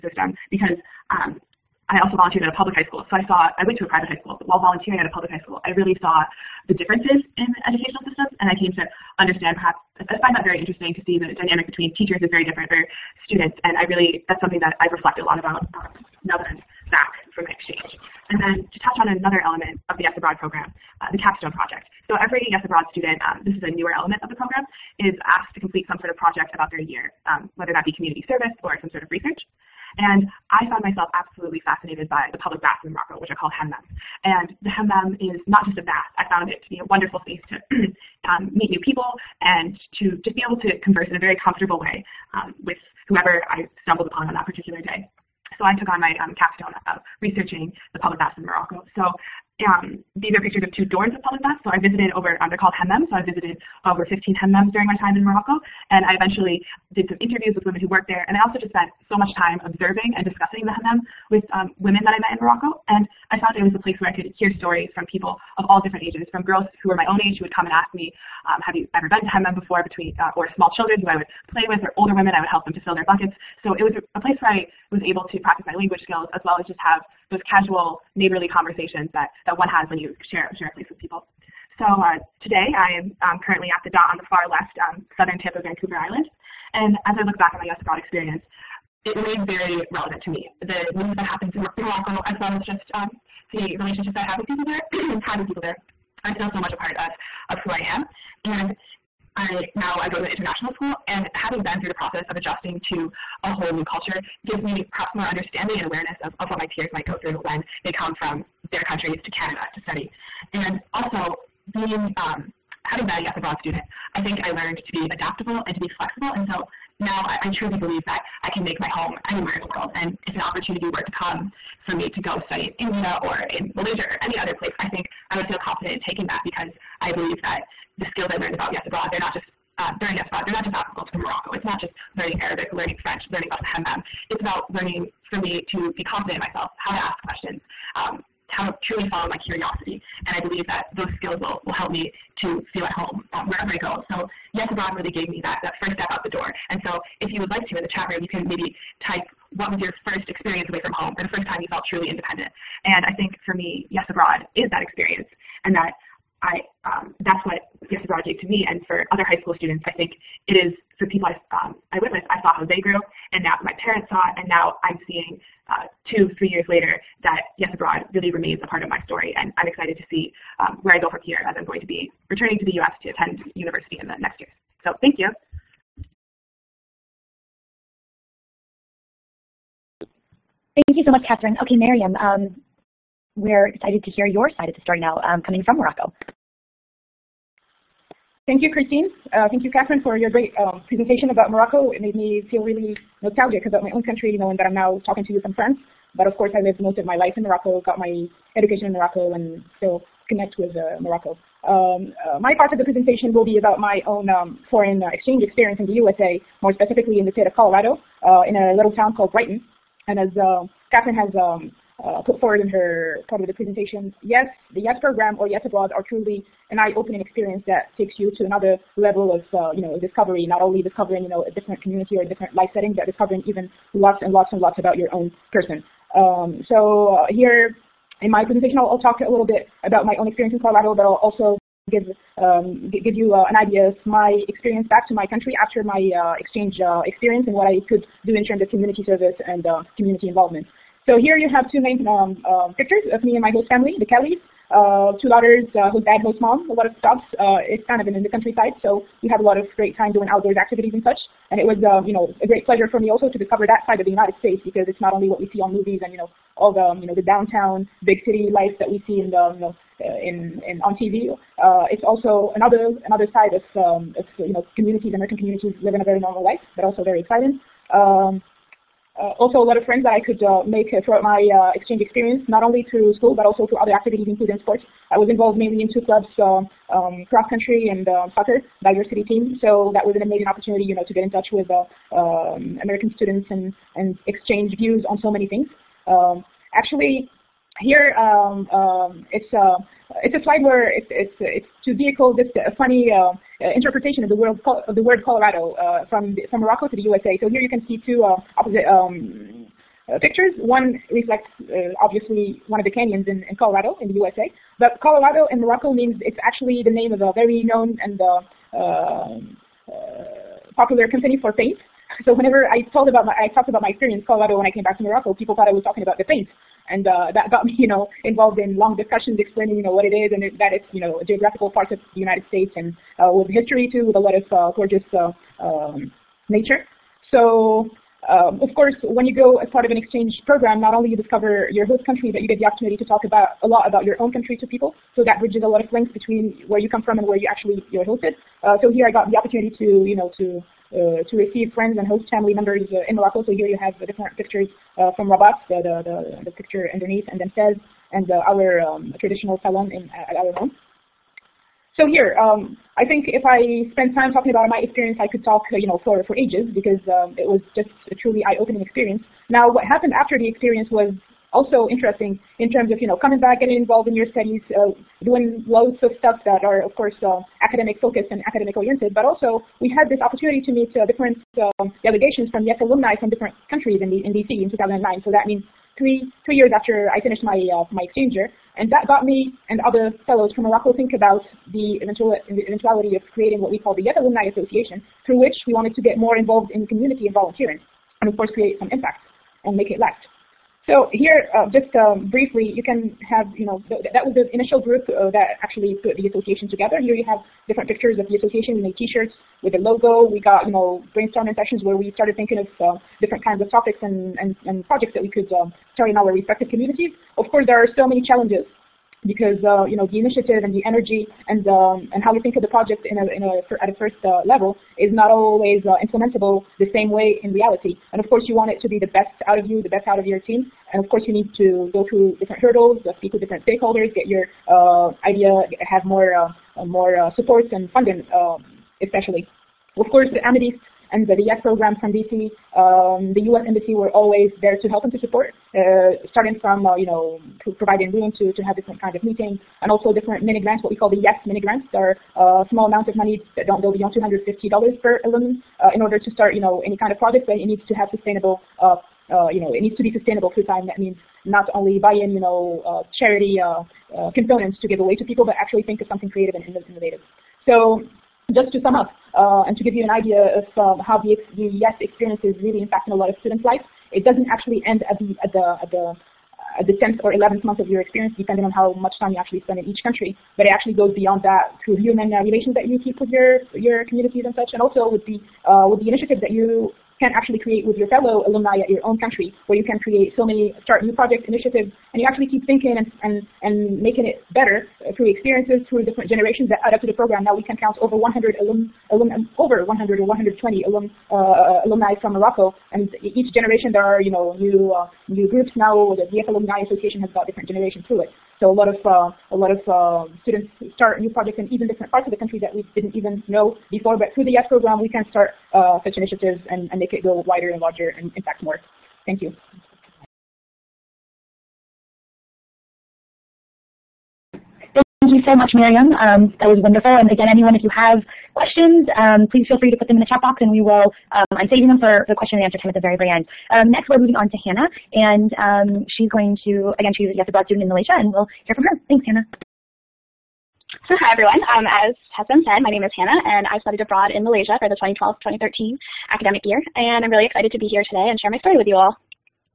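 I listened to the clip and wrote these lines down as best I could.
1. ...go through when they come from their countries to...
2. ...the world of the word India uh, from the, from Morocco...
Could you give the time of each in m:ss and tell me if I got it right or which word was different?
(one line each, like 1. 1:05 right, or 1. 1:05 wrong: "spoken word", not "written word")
1. 1:47 right
2. 4:54 wrong: "Colorado", not "India".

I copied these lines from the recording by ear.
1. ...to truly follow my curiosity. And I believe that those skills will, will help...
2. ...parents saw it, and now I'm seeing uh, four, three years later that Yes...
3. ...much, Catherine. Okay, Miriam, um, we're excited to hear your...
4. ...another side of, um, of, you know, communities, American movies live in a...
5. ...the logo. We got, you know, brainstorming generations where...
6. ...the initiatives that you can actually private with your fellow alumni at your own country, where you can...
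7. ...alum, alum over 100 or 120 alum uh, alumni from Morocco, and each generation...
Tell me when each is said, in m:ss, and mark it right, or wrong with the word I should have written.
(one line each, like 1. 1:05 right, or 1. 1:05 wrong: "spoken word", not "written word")
1. 2:18 right
2. 2:43 wrong: "two", not "four"
3. 3:01 right
4. 4:23 wrong: "communities", not "movies"
5. 6:39 wrong: "sessions", not "generations"
6. 7:56 wrong: "create", not "private"
7. 8:08 right.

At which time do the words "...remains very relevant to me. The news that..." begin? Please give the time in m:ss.
1:29.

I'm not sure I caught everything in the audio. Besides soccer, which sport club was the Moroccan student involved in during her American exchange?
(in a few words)
cross country.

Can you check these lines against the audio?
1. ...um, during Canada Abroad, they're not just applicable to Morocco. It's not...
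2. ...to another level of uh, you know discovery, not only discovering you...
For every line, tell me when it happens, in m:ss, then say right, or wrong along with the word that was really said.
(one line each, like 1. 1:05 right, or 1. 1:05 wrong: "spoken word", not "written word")
1. 2:09 wrong: "Yes", not "Canada"
2. 3:38 right.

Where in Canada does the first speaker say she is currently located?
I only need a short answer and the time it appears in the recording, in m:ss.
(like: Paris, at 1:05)
Vancouver Island, at 1:25.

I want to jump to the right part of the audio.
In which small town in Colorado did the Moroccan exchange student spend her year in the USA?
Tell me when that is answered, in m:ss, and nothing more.
3:28.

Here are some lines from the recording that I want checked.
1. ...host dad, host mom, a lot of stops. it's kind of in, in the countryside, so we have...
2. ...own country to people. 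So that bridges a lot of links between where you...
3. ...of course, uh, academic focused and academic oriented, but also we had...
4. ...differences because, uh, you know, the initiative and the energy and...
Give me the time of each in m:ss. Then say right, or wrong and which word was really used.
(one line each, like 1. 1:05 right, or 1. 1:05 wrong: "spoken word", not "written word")
1. 4:05 right
2. 5:34 right
3. 6:06 right
4. 6:48 wrong: "challenges", not "differences".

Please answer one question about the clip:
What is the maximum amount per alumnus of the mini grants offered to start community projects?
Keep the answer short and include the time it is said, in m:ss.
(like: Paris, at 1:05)
$250, at 7:24.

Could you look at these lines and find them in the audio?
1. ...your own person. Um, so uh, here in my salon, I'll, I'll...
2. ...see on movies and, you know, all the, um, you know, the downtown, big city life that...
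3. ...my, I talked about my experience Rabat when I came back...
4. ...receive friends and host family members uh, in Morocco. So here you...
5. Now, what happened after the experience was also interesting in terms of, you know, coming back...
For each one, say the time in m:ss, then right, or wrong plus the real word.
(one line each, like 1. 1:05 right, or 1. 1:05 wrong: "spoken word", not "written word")
1. 3:44 wrong: "presentation", not "salon"
2. 4:15 right
3. 5:13 wrong: "Colorado", not "Rabat"
4. 5:41 right
5. 5:59 right.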